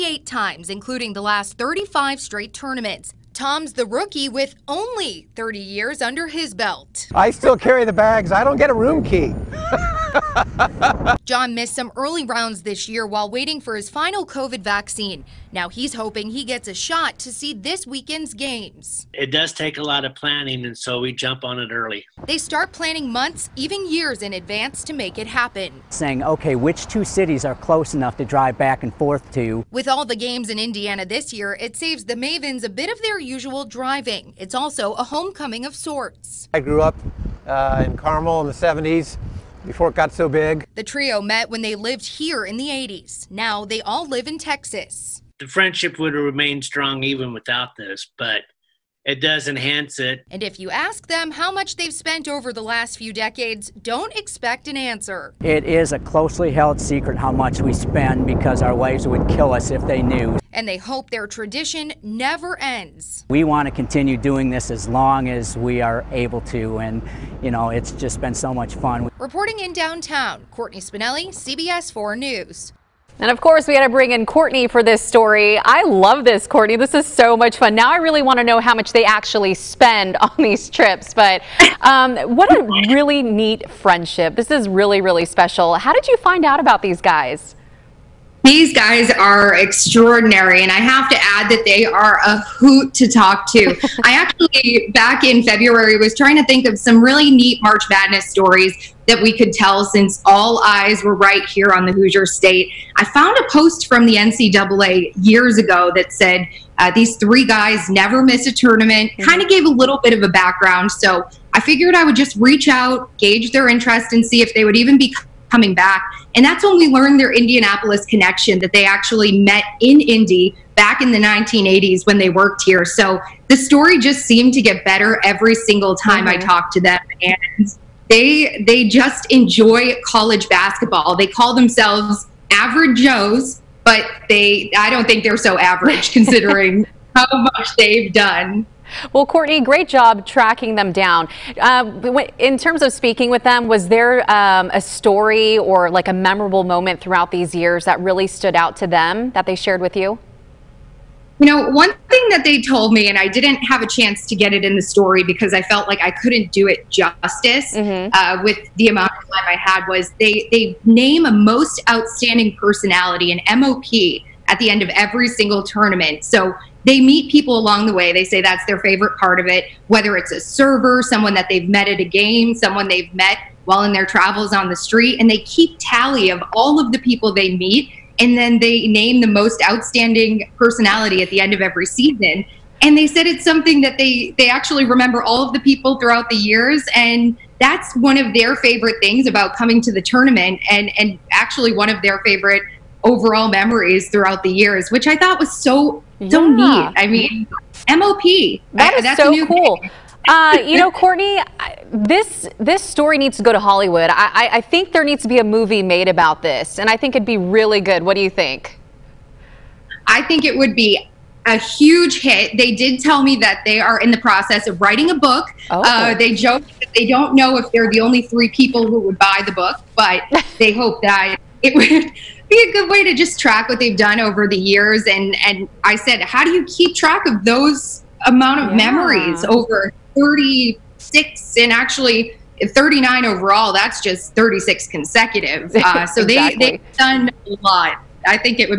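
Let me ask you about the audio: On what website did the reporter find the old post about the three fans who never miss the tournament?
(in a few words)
NCAA.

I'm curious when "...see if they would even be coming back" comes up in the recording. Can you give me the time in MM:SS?
01:54.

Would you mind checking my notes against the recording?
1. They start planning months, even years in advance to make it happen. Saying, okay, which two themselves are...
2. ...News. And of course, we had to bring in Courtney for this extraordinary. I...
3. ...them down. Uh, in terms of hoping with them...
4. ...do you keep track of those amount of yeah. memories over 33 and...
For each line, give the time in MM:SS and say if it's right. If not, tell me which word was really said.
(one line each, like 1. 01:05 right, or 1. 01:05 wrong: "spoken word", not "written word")
1. 00:22 wrong: "cities", not "themselves"
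2. 01:12 wrong: "story", not "extraordinary"
3. 02:20 wrong: "speaking", not "hoping"
4. 03:46 wrong: "36", not "33".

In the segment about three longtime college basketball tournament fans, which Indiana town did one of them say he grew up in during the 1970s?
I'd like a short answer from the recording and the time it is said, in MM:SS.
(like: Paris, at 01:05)
Carmel, at 00:37.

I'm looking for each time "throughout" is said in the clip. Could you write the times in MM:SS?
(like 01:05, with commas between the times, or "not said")
02:26, 03:05, 03:14.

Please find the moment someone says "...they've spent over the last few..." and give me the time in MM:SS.
00:51.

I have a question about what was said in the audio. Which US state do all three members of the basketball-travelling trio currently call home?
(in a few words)
Texas.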